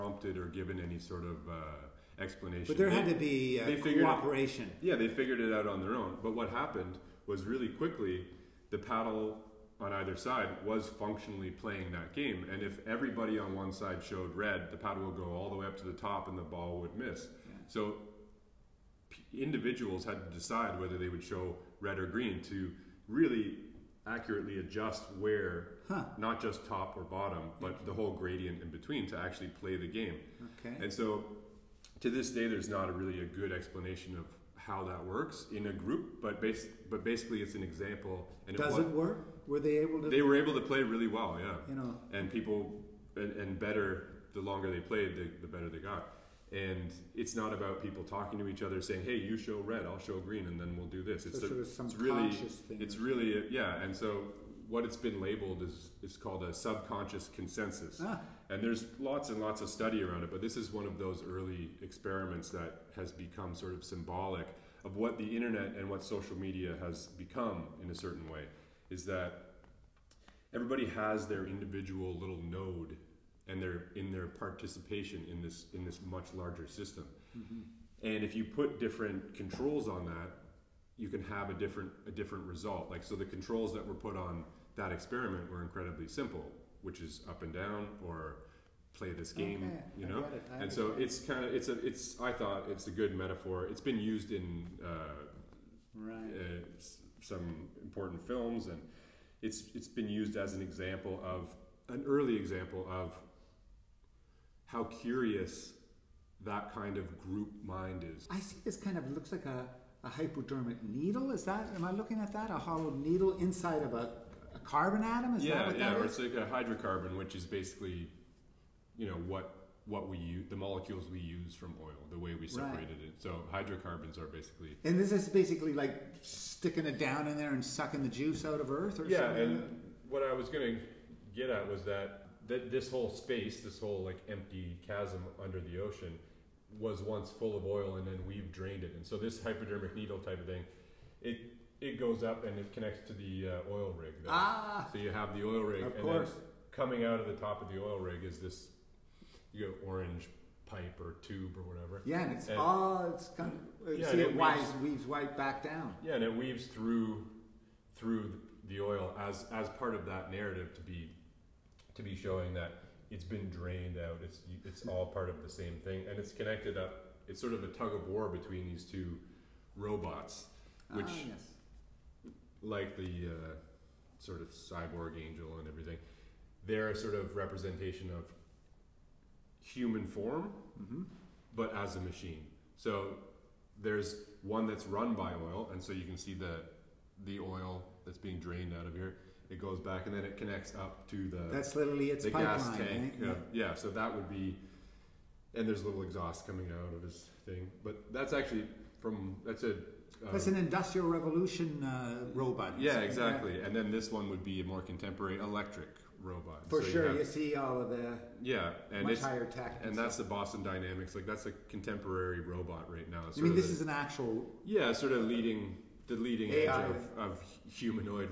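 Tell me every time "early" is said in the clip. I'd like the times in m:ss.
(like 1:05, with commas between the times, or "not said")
1:01, 1:42.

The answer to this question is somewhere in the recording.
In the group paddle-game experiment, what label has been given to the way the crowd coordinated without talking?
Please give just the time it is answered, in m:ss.
0:56.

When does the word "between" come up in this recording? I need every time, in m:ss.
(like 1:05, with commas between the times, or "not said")
0:28, 2:48.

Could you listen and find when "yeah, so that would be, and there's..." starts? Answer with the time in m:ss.
3:13.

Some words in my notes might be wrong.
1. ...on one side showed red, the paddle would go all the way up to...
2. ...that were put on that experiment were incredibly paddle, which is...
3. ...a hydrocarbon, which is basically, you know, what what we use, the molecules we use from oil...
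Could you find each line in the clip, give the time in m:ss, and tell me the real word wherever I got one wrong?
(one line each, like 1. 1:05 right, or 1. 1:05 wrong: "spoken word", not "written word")
1. 0:13 right
2. 1:23 wrong: "simple", not "paddle"
3. 1:56 right.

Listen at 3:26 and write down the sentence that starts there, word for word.
For so sure, you, have, you, see all of the yeah, and much higher tech.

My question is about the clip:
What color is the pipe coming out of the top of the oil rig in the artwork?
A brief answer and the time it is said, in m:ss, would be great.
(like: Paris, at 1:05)
orange, at 2:29.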